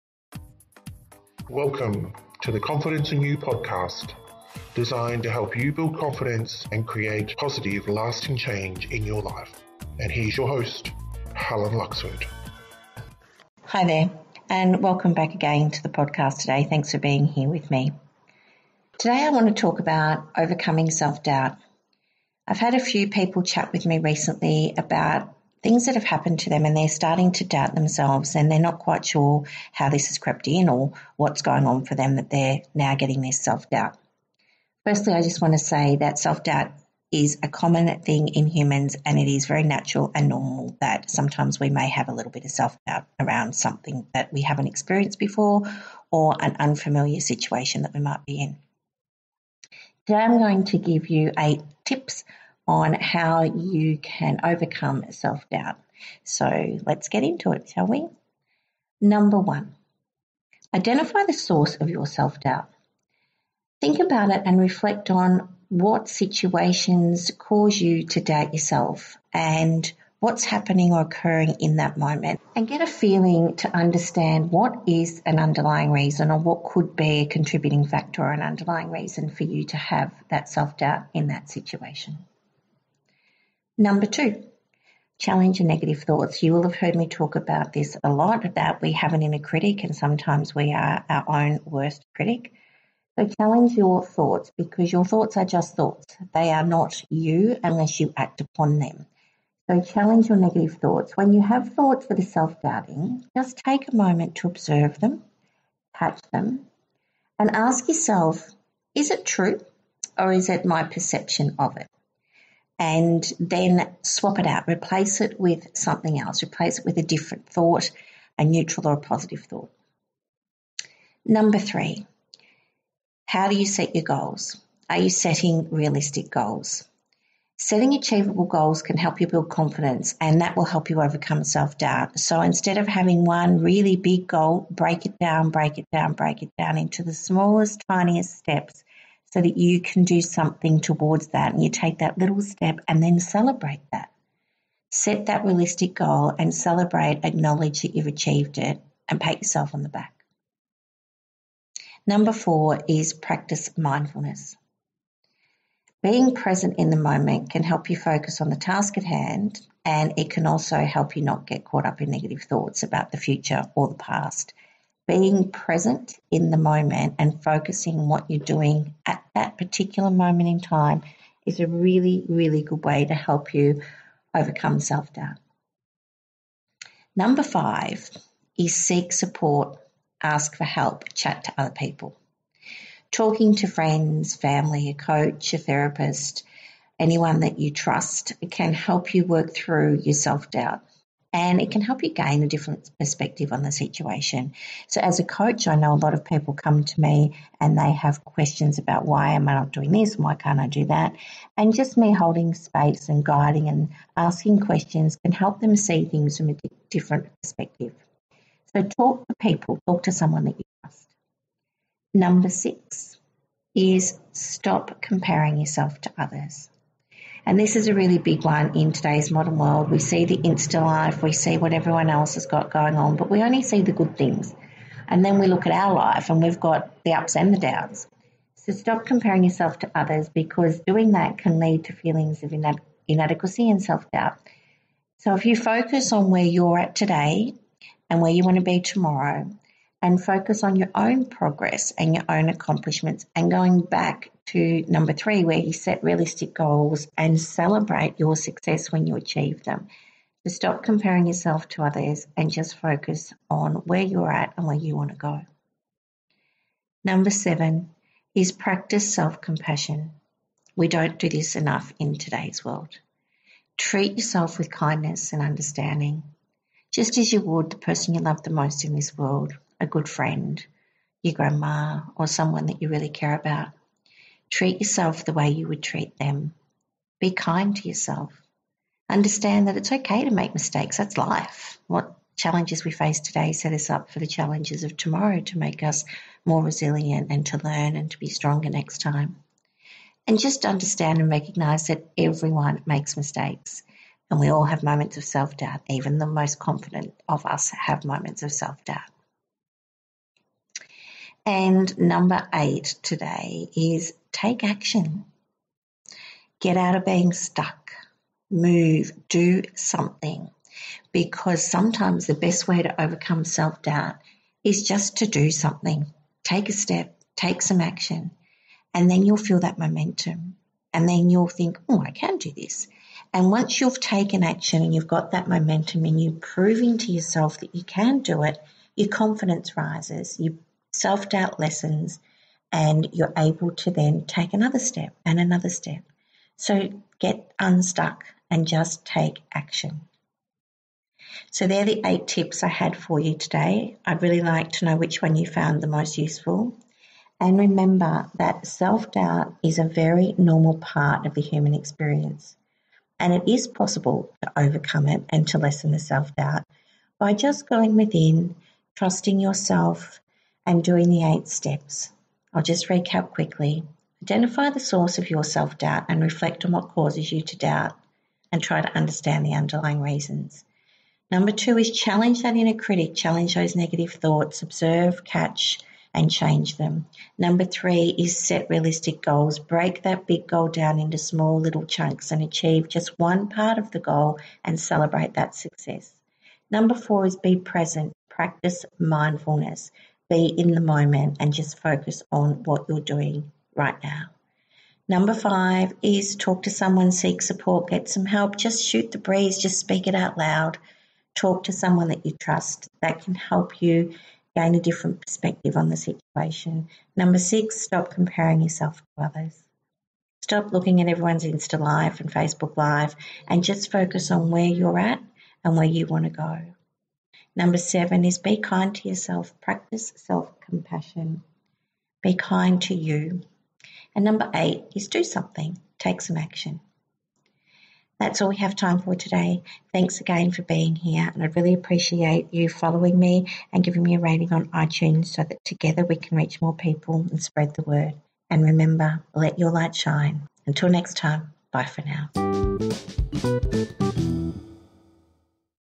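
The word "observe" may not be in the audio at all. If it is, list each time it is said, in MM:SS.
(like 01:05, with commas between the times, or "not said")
01:44, 06:14.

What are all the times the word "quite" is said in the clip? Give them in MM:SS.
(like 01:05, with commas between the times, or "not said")
00:28.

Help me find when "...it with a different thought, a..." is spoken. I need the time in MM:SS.
01:56.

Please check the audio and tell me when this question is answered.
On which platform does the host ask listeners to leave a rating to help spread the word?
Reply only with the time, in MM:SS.
07:14.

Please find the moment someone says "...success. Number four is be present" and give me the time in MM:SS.
06:25.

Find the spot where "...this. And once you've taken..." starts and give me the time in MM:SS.
05:22.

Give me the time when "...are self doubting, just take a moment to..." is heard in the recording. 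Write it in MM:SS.
01:42.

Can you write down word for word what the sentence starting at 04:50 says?
And just understand and recognize that everyone makes mistakes.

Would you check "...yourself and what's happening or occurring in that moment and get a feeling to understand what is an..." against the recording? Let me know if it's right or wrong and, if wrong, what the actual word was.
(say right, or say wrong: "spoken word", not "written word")
right.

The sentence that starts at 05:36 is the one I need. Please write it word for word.
So get unstuck and just take action.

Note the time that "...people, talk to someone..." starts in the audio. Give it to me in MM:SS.
03:29.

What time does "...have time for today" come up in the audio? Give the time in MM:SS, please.
07:08.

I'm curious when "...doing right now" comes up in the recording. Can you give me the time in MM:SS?
06:33.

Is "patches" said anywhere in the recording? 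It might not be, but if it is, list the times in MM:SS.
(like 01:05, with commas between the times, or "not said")
not said.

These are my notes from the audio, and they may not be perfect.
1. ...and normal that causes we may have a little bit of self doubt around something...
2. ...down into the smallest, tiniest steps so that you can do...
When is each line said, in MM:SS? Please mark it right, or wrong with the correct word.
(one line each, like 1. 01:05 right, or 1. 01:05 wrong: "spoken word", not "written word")
1. 00:40 wrong: "sometimes", not "causes"
2. 02:16 right.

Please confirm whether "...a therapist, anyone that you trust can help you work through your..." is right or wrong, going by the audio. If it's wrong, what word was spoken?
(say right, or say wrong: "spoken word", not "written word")
right.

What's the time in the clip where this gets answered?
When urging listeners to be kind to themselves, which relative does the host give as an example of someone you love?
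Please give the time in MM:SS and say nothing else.
04:31.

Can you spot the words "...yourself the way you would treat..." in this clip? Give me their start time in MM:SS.
04:34.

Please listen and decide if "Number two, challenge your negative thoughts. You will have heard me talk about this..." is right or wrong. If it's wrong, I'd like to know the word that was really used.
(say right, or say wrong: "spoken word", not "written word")
right.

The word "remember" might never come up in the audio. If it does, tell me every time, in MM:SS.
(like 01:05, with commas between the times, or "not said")
05:47, 07:18.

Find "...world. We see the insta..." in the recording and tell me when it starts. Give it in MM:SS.
03:39.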